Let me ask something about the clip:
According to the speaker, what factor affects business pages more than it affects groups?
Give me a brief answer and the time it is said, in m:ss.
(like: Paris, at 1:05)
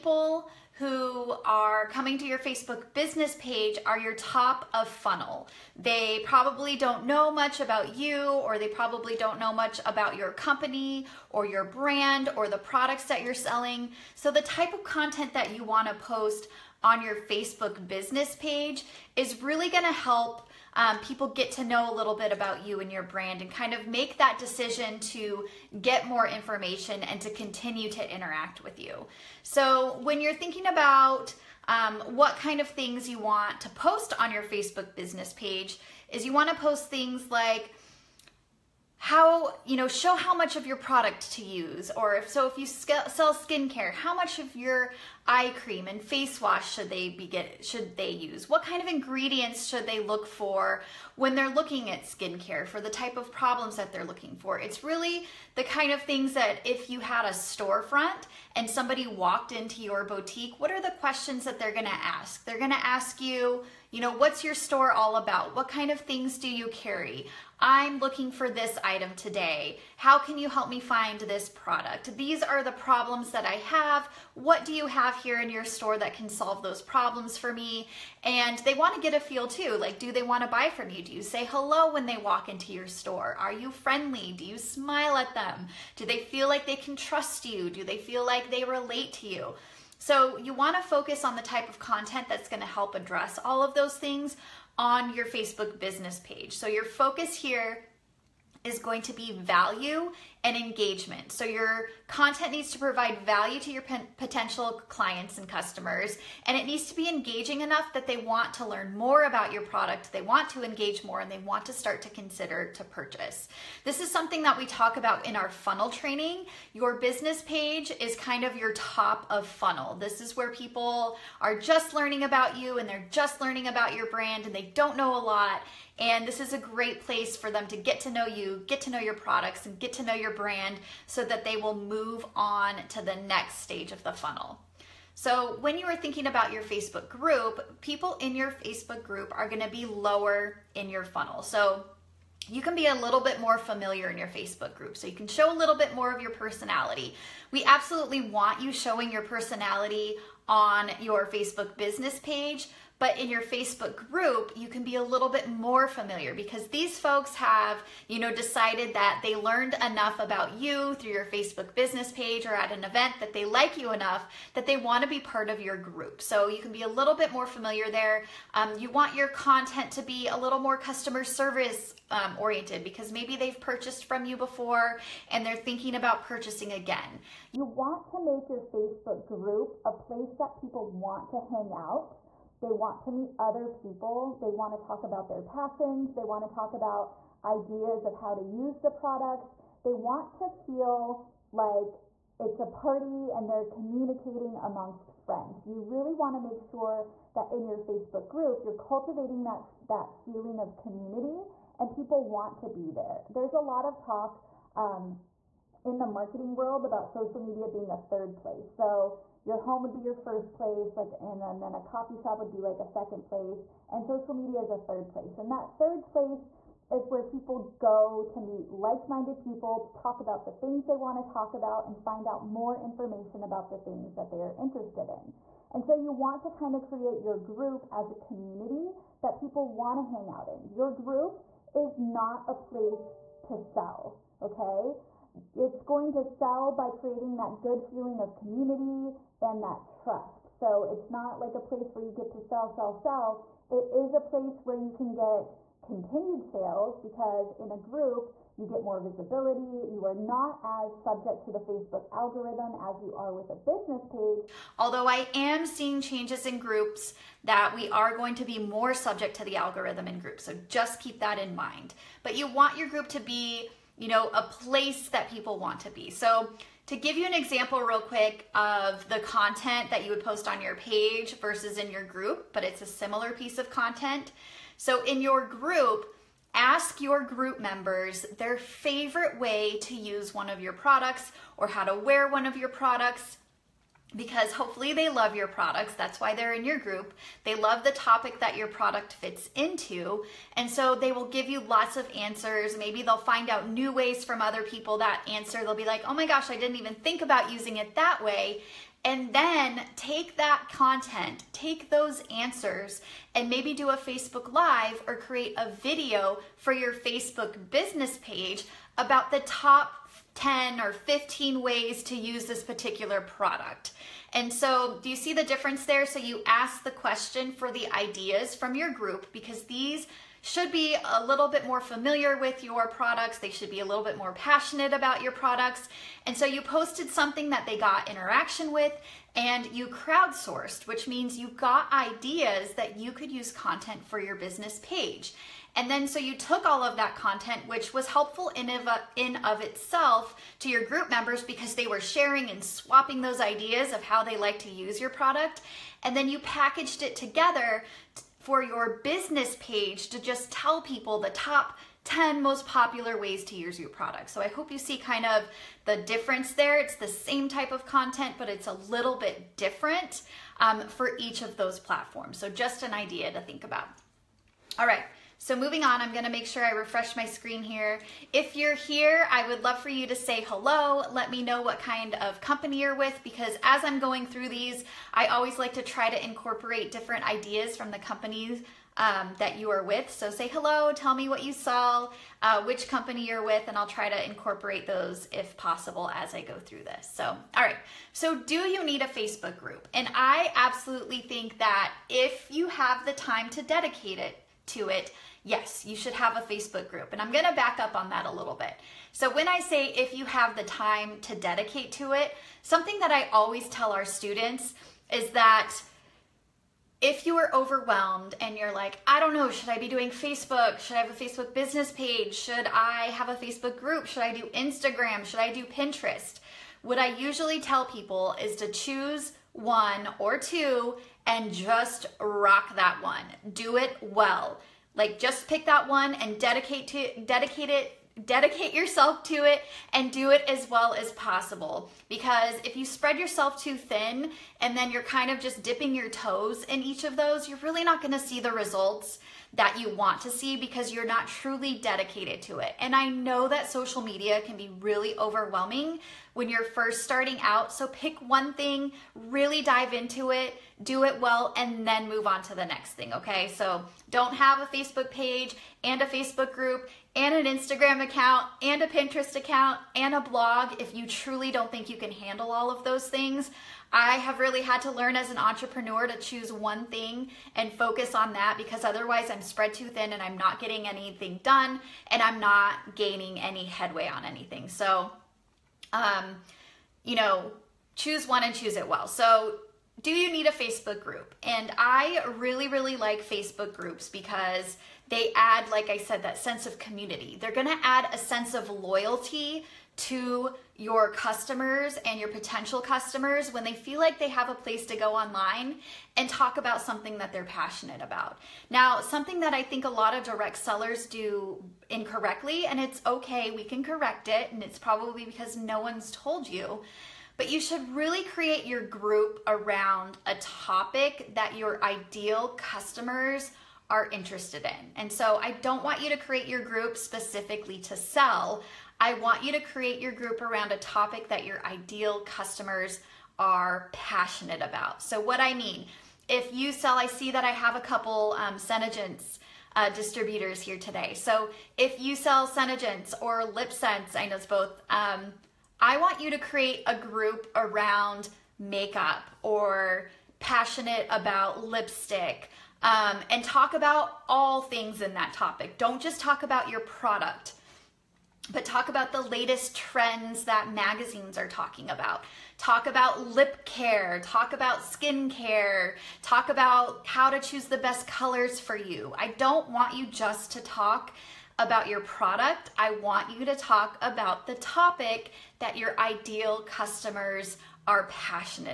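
the Facebook algorithm, at 4:11.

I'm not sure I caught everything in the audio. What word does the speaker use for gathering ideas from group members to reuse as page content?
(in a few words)
crowdsourced.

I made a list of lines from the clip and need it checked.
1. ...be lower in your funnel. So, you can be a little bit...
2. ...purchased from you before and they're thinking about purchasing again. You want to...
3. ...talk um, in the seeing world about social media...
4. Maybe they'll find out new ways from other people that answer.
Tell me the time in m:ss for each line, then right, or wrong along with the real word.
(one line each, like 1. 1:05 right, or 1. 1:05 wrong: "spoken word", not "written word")
1. 2:19 right
2. 2:53 right
3. 3:23 wrong: "marketing", not "seeing"
4. 4:52 right.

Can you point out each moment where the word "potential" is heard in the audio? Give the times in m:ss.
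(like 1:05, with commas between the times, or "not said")
1:44, 8:12.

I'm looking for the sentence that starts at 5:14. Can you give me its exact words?
And so, do you see the difference there?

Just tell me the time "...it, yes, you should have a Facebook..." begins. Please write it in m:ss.
6:34.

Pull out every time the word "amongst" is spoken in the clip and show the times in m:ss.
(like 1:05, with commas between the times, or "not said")
3:14.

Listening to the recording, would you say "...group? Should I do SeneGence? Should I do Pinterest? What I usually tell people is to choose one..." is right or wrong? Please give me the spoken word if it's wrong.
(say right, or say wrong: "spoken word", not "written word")
wrong: "Instagram", not "SeneGence".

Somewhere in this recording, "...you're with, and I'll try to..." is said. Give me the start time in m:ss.
6:23.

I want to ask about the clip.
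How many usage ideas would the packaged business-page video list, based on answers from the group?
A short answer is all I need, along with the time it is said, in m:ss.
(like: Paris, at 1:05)
top 10 or 15, at 5:09.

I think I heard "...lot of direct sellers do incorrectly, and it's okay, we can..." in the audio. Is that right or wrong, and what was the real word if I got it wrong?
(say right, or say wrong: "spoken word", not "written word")
right.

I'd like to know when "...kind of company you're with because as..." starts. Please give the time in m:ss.
6:11.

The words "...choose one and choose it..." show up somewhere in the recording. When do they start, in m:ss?
7:57.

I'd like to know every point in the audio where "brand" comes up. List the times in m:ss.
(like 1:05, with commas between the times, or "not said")
0:11, 0:23, 2:04, 2:10.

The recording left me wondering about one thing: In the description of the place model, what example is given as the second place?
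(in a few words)
coffee shop.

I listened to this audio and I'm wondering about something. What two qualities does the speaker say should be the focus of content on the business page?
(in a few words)
value and engagement.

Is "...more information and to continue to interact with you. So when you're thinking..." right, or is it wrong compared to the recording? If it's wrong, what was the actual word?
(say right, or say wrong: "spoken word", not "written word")
right.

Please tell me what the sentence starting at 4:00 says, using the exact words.
So it's not like a place where you get to sell, sell, sell.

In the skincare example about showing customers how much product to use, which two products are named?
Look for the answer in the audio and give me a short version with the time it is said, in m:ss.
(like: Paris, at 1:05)
eye cream and face wash, at 0:45.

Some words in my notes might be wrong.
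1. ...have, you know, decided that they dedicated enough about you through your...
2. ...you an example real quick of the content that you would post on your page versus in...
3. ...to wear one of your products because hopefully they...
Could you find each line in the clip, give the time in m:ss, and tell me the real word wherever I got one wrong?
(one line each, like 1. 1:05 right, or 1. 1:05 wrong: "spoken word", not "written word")
1. 2:37 wrong: "learned", not "dedicated"
2. 4:27 right
3. 4:41 right.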